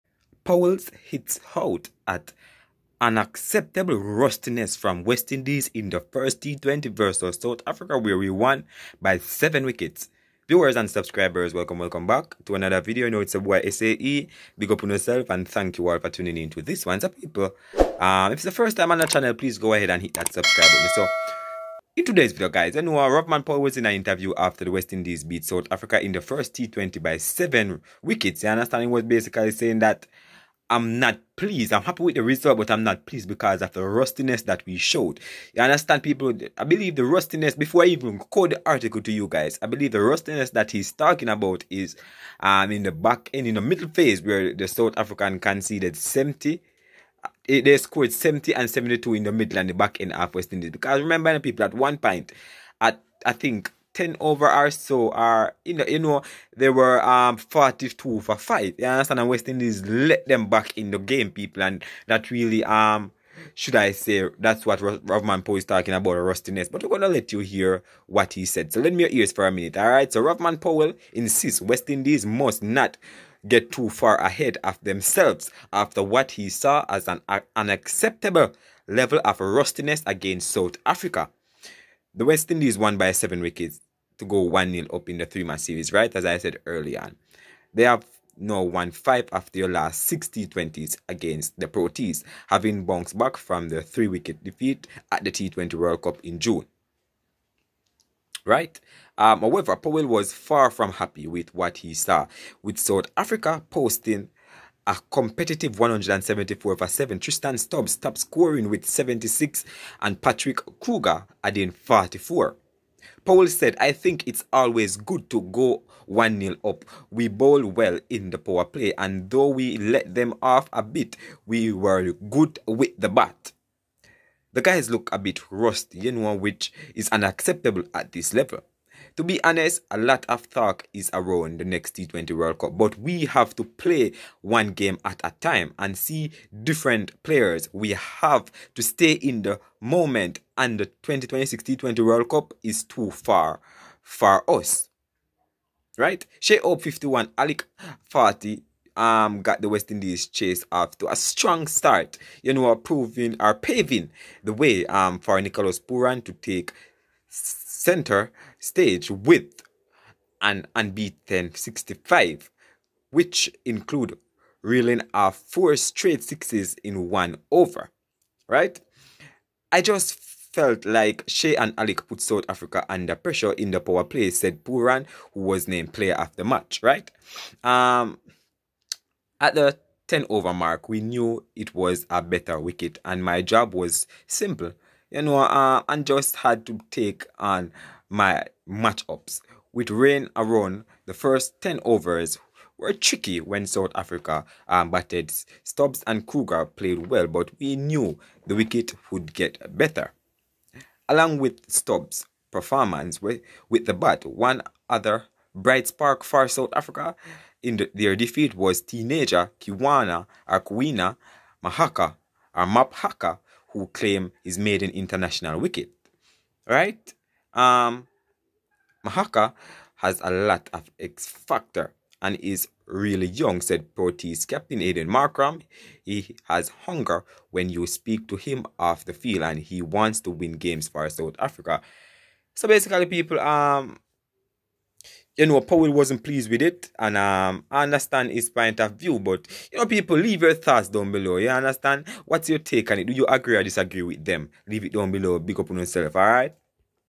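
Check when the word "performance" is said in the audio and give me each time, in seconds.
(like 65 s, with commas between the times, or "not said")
202 s.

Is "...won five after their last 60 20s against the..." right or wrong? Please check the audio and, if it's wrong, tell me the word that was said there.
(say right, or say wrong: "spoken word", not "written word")
right.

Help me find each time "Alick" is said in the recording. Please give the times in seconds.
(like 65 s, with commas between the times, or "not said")
147 s, 171 s.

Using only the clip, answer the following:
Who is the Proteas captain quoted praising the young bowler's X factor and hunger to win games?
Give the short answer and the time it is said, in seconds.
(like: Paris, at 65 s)
Aidan Markram, at 224 s.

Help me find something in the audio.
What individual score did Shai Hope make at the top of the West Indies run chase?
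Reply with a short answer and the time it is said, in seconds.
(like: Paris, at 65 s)
51, at 146 s.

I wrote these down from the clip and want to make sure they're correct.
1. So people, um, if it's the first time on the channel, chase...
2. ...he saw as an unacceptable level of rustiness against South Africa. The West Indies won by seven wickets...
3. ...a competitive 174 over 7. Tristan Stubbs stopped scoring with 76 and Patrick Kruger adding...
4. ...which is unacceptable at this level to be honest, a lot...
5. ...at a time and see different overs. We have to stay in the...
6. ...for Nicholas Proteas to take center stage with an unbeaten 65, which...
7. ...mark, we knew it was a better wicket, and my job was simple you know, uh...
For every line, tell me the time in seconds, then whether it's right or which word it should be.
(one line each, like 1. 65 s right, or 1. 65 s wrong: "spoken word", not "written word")
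1. 16 s wrong: "please", not "chase"
2. 76 s right
3. 104 s right
4. 126 s right
5. 135 s wrong: "players", not "overs"
6. 155 s wrong: "Pooran", not "Proteas"
7. 180 s right.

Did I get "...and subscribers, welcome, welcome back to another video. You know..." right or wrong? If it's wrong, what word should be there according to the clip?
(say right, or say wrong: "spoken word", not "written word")
right.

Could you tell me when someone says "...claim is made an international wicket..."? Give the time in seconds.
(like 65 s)
213 s.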